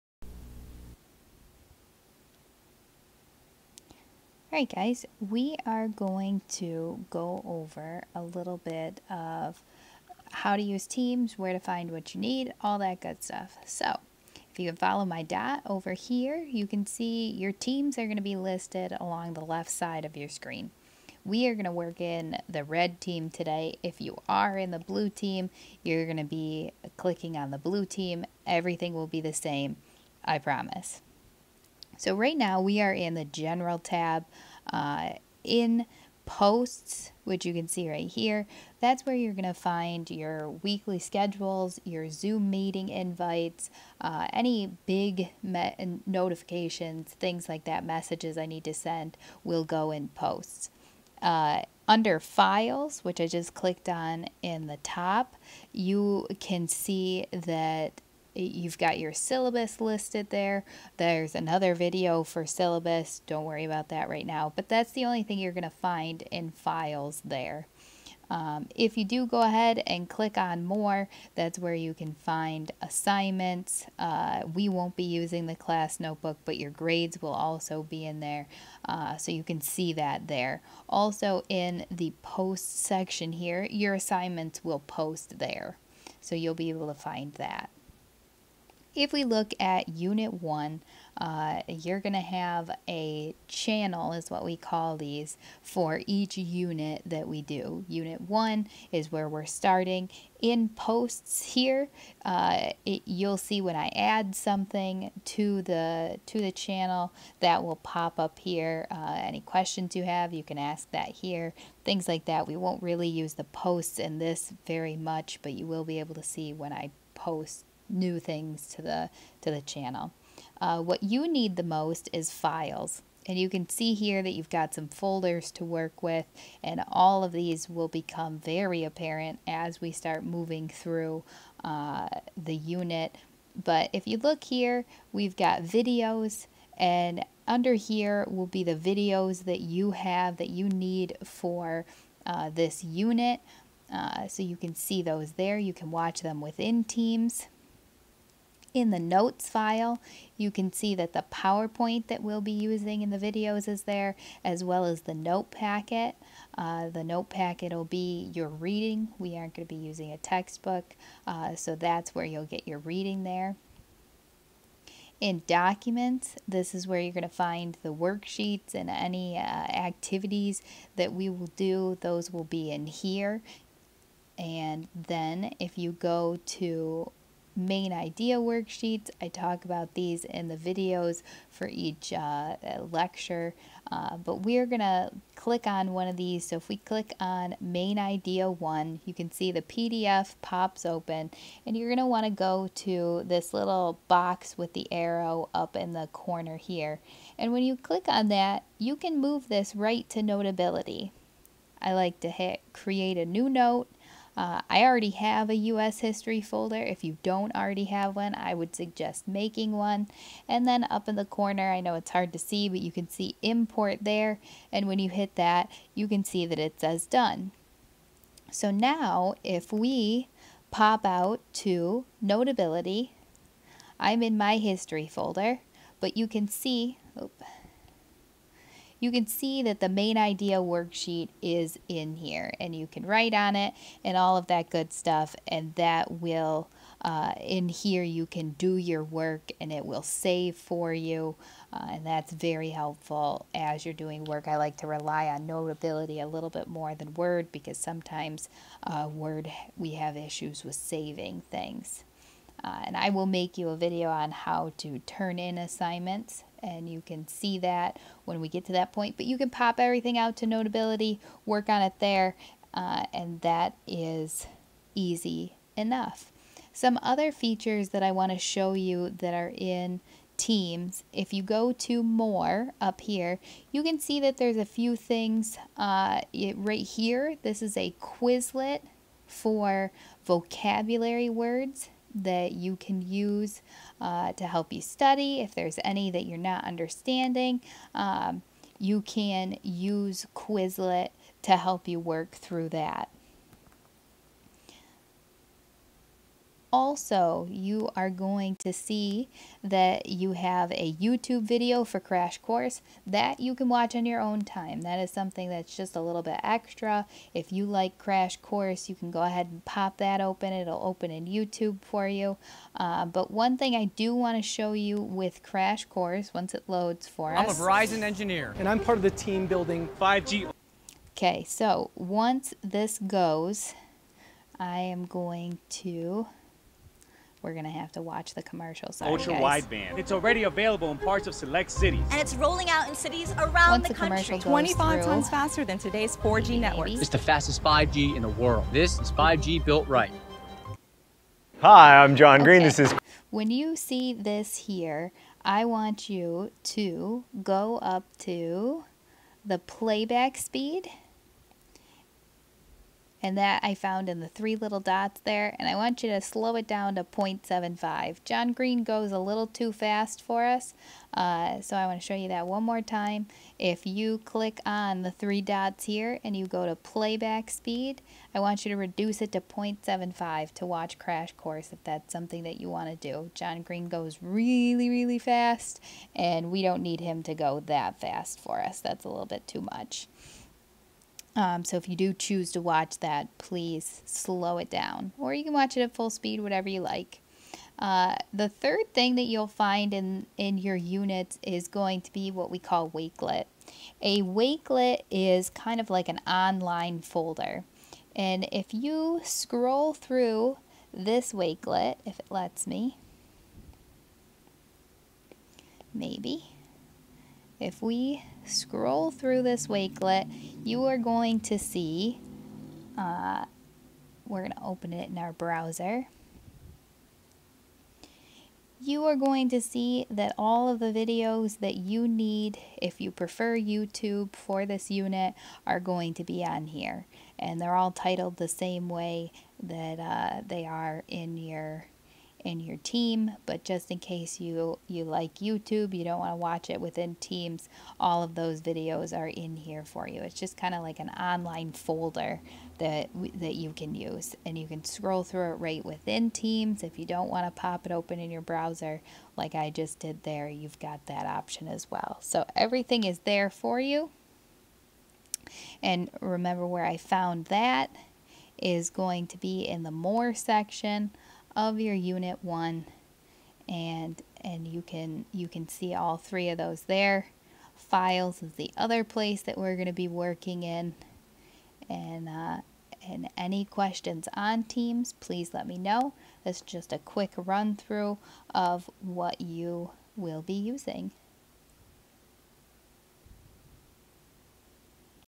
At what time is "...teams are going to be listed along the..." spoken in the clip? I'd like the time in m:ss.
0:17.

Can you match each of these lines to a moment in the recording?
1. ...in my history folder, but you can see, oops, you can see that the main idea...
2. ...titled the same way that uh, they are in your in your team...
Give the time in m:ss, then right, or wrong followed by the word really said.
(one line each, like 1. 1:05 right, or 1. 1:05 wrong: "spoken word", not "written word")
1. 3:44 right
2. 7:07 right.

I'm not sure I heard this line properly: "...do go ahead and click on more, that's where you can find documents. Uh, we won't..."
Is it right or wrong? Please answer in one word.
wrong.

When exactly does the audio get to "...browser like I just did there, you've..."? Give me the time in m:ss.
7:28.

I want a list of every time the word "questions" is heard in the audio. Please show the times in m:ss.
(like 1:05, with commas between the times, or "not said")
1:49, 7:53.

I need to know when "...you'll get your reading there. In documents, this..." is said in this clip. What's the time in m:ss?
2:42.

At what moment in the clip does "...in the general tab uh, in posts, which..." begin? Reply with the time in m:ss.
0:32.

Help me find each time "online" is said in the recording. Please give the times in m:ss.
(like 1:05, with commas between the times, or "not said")
6:36, 7:21.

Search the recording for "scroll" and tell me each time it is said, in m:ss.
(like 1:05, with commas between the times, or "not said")
6:39, 6:48, 7:24.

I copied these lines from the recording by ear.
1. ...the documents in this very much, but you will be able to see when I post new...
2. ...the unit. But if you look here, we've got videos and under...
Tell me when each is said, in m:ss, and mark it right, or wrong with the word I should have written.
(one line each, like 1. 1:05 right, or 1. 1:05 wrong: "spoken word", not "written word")
1. 1:53 wrong: "posts", not "documents"
2. 2:12 right.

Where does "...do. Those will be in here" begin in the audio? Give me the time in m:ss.
2:51.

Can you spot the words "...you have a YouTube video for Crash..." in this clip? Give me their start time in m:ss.
5:00.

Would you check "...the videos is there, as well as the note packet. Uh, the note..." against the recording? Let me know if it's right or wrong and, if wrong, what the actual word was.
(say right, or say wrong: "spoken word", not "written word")
right.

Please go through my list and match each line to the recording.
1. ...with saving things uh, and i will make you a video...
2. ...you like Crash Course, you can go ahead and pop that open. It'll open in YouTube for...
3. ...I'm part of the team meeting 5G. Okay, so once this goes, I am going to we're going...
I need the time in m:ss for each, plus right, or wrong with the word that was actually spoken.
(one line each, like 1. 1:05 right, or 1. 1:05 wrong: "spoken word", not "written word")
1. 4:10 right
2. 5:07 right
3. 5:18 wrong: "building", not "meeting".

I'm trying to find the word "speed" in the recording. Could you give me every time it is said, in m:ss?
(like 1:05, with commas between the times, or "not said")
5:50, 6:07, 6:26.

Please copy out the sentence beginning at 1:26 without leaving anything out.
So you'll be able to find that.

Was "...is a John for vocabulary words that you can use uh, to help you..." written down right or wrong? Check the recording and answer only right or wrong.
wrong.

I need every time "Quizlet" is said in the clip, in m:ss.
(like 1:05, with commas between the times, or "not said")
4:38, 4:50.